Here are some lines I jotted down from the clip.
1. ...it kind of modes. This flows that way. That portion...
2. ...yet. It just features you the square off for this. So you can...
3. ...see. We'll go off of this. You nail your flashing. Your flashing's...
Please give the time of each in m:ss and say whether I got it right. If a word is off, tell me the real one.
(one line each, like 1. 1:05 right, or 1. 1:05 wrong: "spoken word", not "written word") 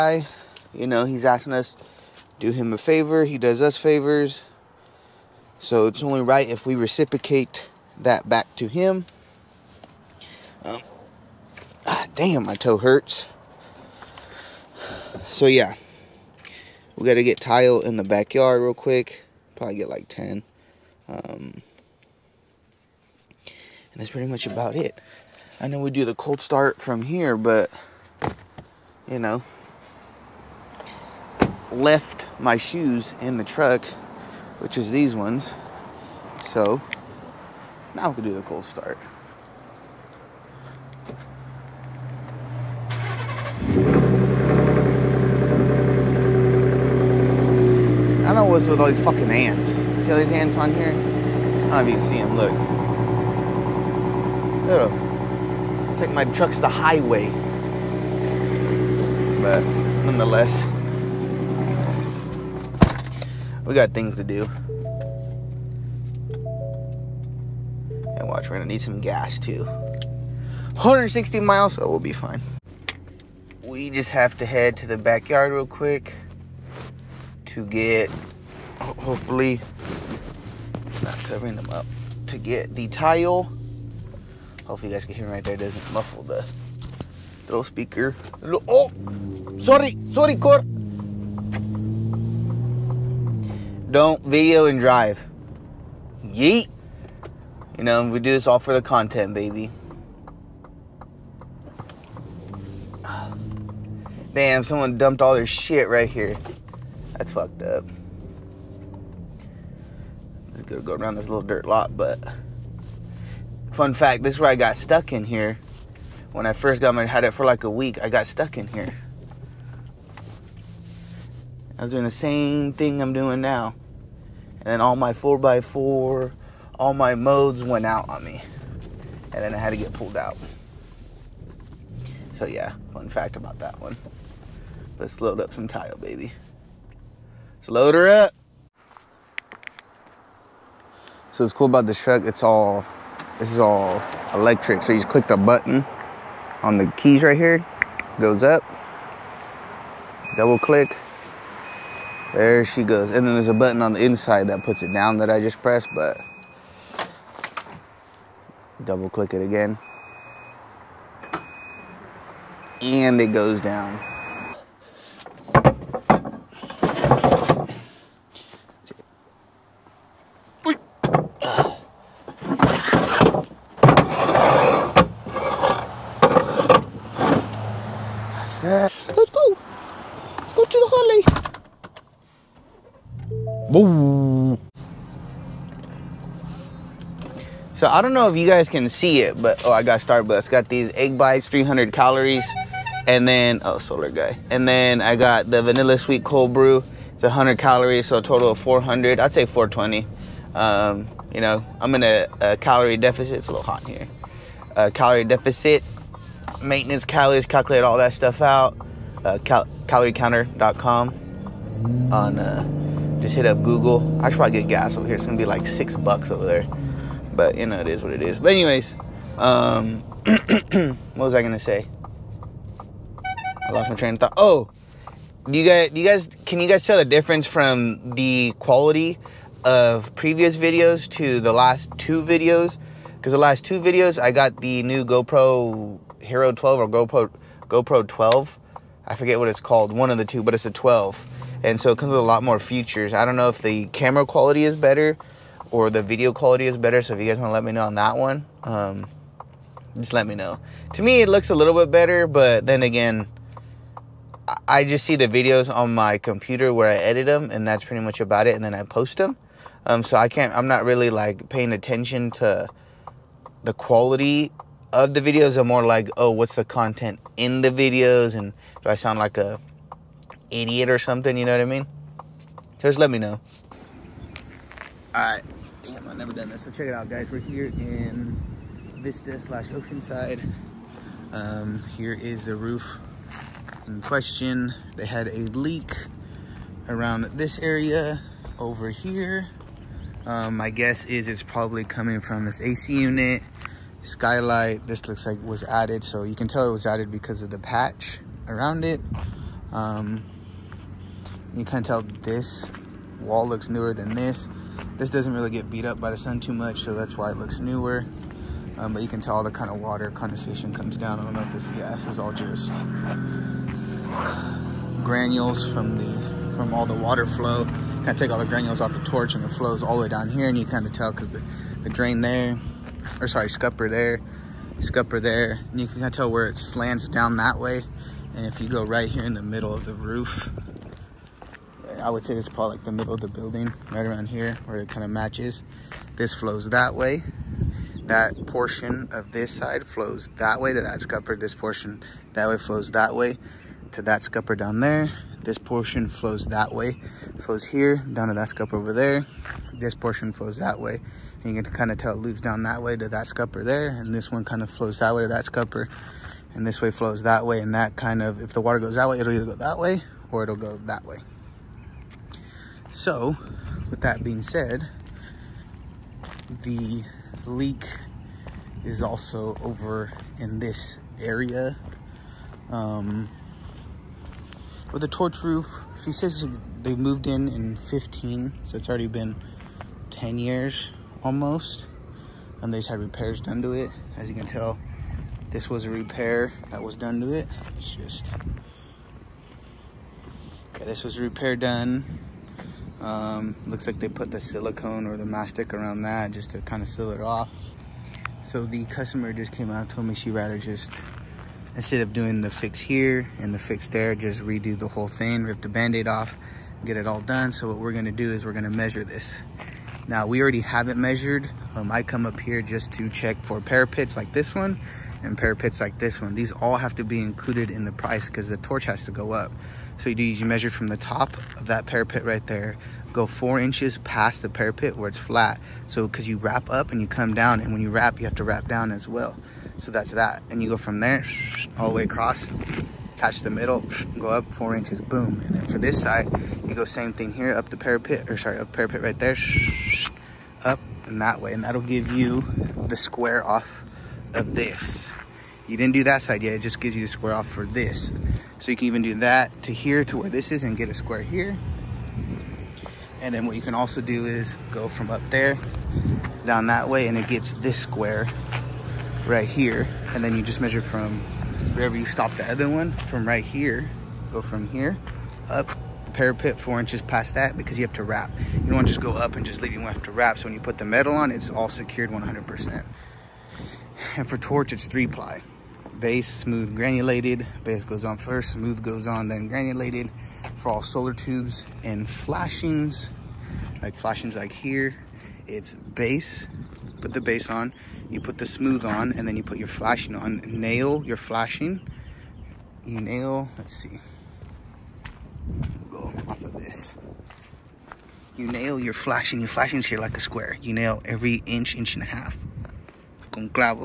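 1. 5:34 wrong: "matches", not "modes"
2. 7:26 wrong: "gives", not "features"
3. 8:13 right.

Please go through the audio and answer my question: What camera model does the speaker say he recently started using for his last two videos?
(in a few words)
GoPro Hero 12.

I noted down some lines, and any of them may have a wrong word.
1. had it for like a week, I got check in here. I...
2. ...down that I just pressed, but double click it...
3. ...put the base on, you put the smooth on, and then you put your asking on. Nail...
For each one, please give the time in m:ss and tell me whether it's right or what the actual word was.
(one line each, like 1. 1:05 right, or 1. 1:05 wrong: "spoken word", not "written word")
1. 1:57 wrong: "stuck", not "check"
2. 2:34 right
3. 8:06 wrong: "flashing", not "asking".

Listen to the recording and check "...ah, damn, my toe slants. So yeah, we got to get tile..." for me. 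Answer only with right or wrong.
wrong.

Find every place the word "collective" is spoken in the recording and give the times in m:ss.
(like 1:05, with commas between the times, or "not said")
not said.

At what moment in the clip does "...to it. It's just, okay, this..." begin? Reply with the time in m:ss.
6:27.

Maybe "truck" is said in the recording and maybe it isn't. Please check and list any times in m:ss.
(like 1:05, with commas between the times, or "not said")
0:33, 0:56, 2:22.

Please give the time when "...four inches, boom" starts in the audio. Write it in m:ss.
7:14.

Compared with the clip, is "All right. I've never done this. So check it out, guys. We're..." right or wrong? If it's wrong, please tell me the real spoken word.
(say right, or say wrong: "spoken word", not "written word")
right.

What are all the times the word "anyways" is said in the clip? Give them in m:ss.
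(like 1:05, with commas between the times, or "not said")
3:38.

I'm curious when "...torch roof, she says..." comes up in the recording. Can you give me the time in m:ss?
6:15.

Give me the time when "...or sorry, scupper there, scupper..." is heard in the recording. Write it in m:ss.
5:23.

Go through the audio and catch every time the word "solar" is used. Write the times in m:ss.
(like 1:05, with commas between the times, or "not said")
3:13, 8:00.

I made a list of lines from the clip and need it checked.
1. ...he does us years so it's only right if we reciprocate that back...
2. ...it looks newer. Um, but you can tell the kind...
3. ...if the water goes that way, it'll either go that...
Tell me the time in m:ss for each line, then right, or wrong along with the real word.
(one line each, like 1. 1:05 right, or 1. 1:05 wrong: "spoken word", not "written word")
1. 0:03 wrong: "favors", not "years"
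2. 5:07 right
3. 5:58 right.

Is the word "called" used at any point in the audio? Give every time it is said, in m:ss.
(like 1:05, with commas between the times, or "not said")
3:59.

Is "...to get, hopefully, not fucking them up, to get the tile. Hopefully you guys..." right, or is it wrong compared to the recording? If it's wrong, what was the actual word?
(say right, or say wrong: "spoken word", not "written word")
wrong: "covering", not "fucking".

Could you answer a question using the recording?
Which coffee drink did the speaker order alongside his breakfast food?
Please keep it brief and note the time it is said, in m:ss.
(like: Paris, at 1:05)
vanilla sweet cold brew, at 3:15.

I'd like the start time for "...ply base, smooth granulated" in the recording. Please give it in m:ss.
7:55.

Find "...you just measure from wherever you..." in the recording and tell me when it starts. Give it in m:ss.
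7:40.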